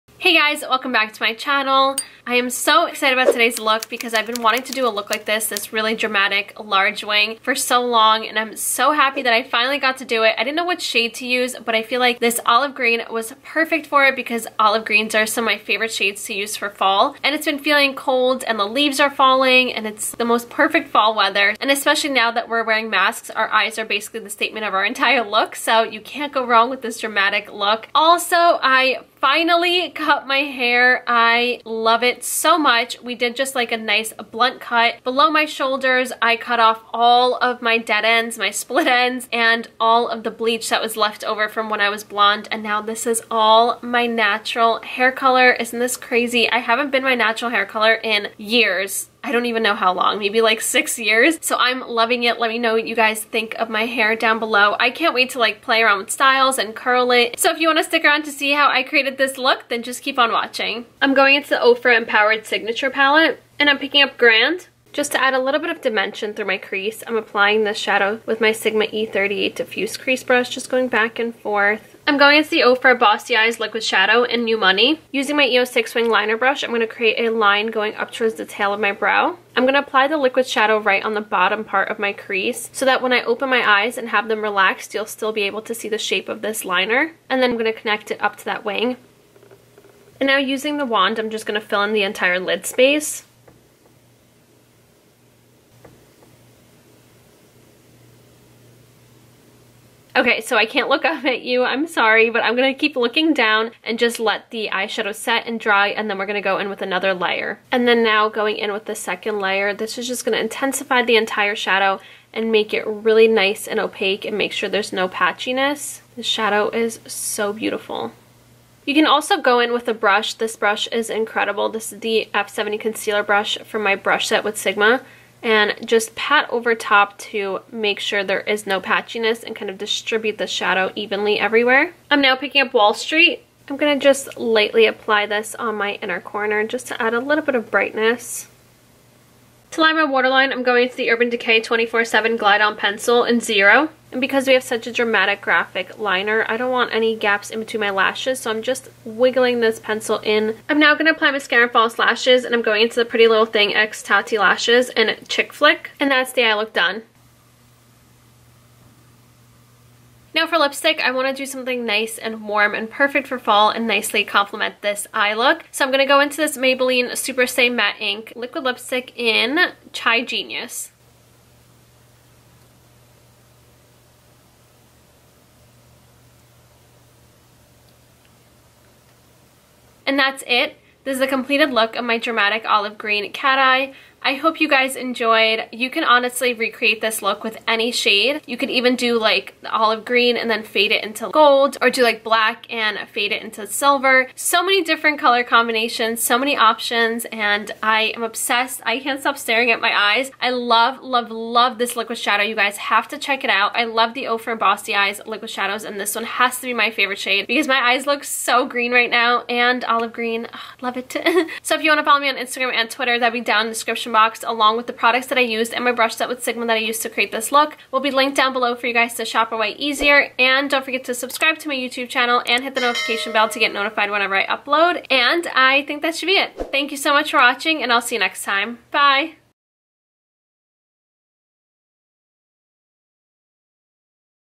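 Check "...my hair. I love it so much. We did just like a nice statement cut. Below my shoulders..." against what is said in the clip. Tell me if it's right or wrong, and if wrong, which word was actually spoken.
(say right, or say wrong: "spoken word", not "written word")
wrong: "blunt", not "statement".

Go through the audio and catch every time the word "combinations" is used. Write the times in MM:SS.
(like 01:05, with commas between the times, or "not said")
03:15.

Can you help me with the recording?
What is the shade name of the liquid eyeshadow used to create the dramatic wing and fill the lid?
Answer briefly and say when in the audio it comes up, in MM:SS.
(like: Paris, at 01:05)
New Money, at 01:14.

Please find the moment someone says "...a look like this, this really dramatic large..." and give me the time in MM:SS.
00:04.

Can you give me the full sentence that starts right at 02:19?
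To line my waterline, I'm going to the Urban Decay 24-7 Glide On Pencil in Zero.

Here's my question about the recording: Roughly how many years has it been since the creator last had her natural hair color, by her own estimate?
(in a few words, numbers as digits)
6.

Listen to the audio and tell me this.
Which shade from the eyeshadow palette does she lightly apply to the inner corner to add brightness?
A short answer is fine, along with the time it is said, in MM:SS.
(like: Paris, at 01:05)
Wall Street, at 02:12.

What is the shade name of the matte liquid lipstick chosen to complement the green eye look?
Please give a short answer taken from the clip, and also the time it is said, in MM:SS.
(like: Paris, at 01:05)
Chai Genius, at 02:49.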